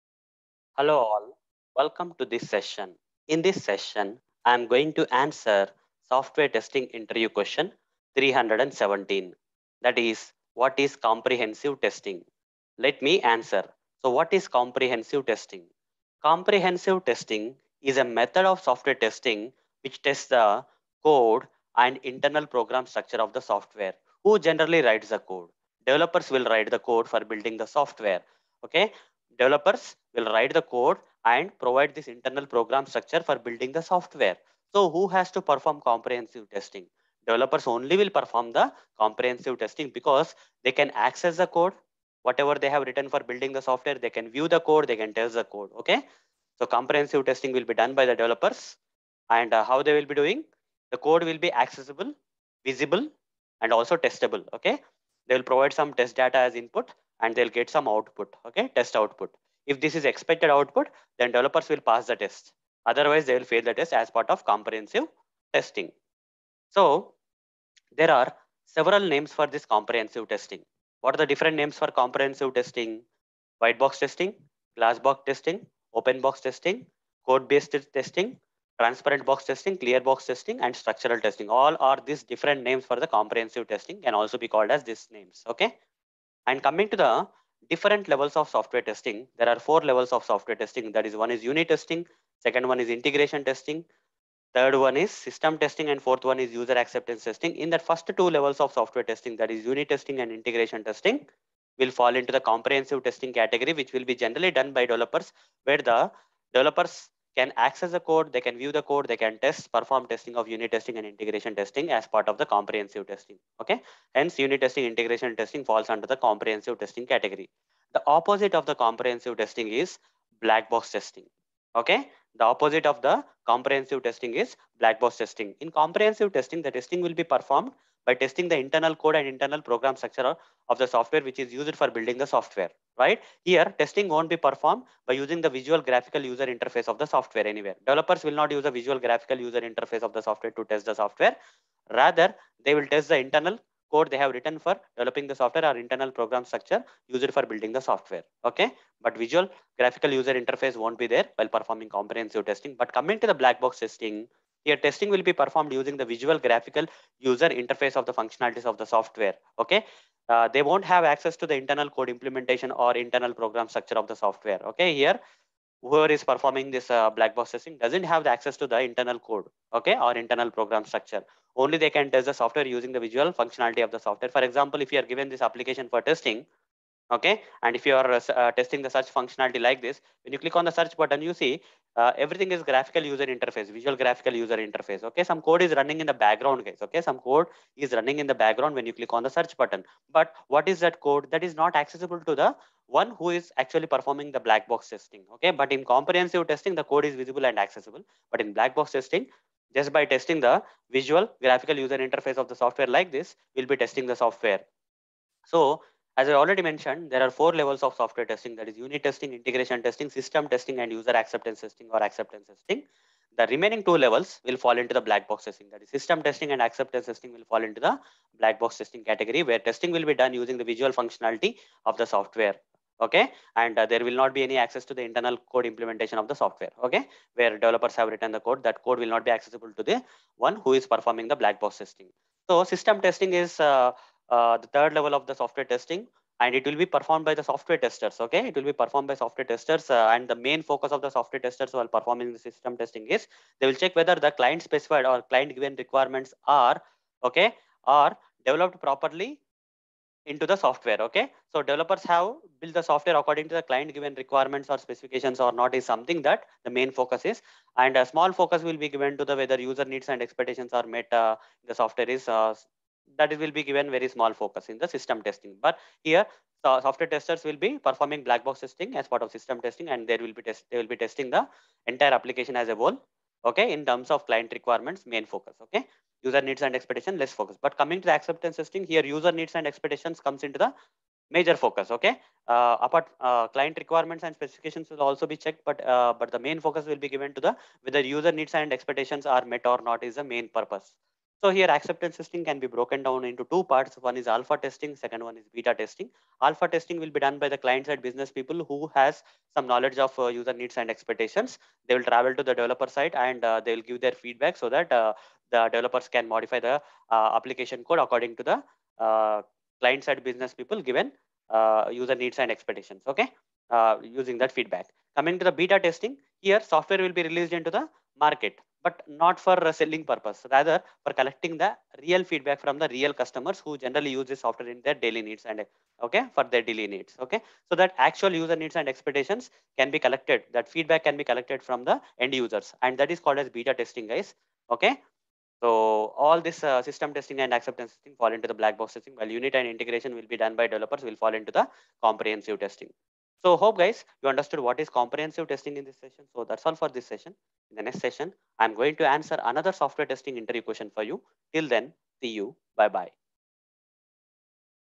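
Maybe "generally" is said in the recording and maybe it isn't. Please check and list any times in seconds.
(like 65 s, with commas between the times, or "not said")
24 s, 104 s, 323 s.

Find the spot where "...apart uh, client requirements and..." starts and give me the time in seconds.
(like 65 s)
282 s.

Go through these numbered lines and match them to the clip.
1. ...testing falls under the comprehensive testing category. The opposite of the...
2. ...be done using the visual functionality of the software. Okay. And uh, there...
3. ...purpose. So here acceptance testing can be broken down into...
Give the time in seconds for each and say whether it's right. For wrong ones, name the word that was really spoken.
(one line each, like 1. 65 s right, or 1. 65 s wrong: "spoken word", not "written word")
1. 115 s right
2. 220 s right
3. 290 s right.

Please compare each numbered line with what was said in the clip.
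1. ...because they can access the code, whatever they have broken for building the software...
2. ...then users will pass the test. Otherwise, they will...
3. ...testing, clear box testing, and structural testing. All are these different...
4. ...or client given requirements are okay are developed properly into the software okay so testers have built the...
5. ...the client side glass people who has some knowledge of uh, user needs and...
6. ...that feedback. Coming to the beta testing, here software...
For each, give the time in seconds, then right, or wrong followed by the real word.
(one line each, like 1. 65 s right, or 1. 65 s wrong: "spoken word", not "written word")
1. 39 s wrong: "written", not "broken"
2. 61 s wrong: "developers", not "users"
3. 79 s right
4. 245 s wrong: "developers", not "testers"
5. 297 s wrong: "business", not "glass"
6. 314 s right.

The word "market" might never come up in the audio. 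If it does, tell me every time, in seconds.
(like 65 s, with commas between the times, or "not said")
318 s.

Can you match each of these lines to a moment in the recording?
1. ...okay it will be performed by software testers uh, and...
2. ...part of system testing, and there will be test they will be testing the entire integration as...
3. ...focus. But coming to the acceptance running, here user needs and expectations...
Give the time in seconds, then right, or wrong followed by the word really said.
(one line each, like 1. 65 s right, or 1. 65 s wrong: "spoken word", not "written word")
1. 238 s right
2. 269 s wrong: "application", not "integration"
3. 277 s wrong: "testing", not "running".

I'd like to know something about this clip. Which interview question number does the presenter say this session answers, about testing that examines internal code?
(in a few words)
317.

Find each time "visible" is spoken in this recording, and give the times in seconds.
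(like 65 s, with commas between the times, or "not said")
52 s, 197 s.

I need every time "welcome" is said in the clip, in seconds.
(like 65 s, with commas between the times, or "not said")
1 s.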